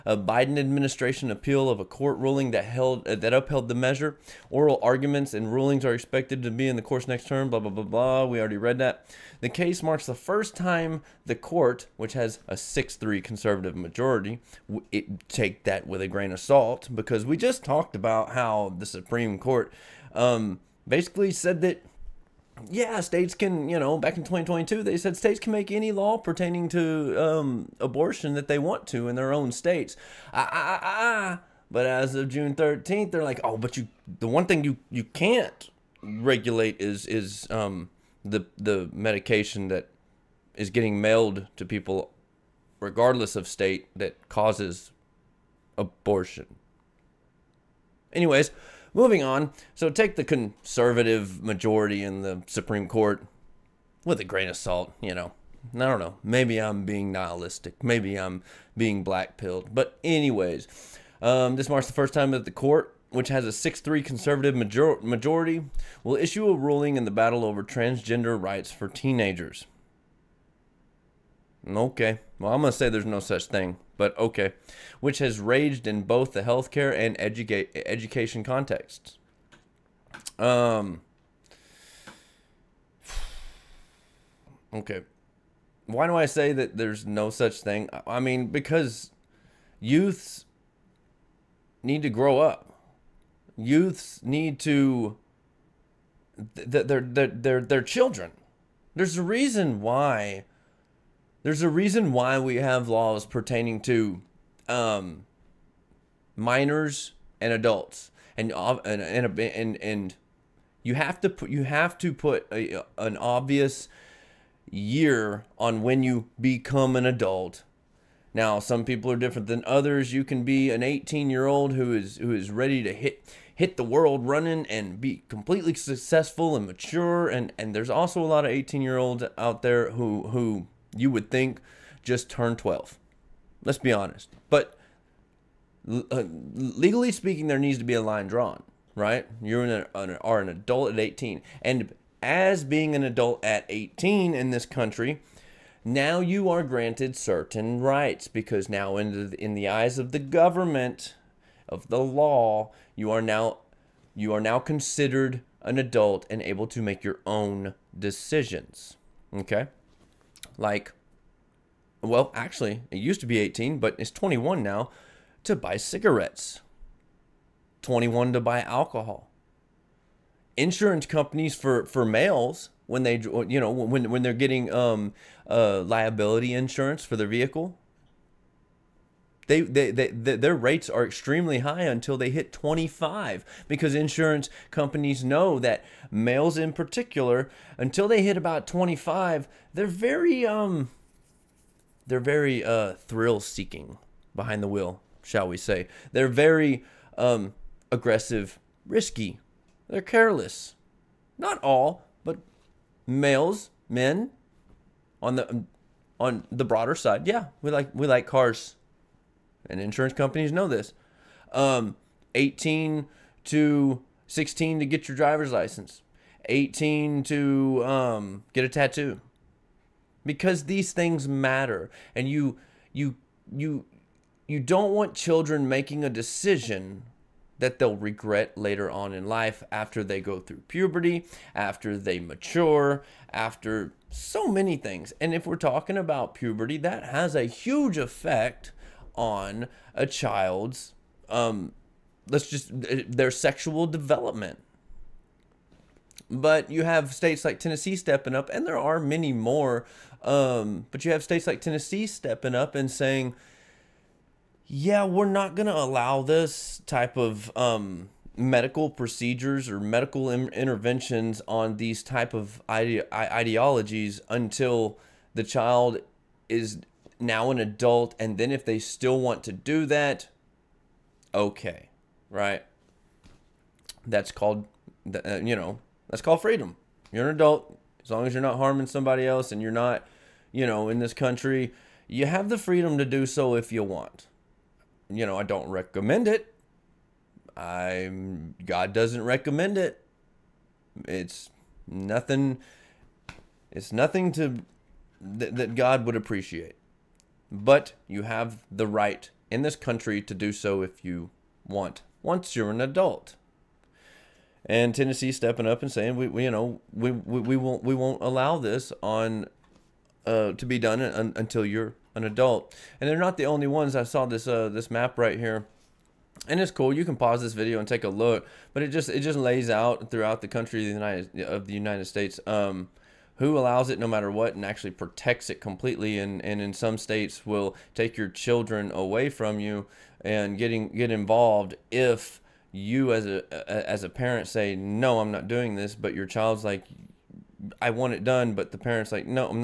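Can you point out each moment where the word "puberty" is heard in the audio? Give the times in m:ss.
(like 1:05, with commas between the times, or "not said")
3:50, 3:56.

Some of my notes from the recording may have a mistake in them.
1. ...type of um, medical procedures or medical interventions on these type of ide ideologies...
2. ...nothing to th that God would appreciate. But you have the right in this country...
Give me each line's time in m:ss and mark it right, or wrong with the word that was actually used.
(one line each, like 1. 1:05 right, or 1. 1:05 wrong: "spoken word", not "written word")
1. 4:16 right
2. 4:53 right.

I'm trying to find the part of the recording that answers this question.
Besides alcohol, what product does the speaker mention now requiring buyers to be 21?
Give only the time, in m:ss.
2:45.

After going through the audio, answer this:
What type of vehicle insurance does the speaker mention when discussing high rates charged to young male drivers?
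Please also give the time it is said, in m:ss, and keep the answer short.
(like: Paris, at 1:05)
Liability insurance, at 2:55.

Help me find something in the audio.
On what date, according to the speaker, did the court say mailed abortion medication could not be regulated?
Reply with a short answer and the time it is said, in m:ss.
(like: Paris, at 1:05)
June 13th, at 0:32.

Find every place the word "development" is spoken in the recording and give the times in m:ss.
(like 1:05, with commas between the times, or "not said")
4:03.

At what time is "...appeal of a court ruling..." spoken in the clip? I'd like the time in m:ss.
0:01.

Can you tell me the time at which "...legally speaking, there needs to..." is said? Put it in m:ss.
2:16.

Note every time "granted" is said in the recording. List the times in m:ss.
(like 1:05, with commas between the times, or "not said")
2:26.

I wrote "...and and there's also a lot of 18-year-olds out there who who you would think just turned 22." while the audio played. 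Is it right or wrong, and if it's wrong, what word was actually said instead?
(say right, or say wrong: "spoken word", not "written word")
wrong: "12", not "22".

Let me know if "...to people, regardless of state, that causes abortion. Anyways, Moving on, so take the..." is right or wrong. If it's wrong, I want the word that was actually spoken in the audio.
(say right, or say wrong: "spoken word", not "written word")
right.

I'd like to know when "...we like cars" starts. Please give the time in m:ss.
3:27.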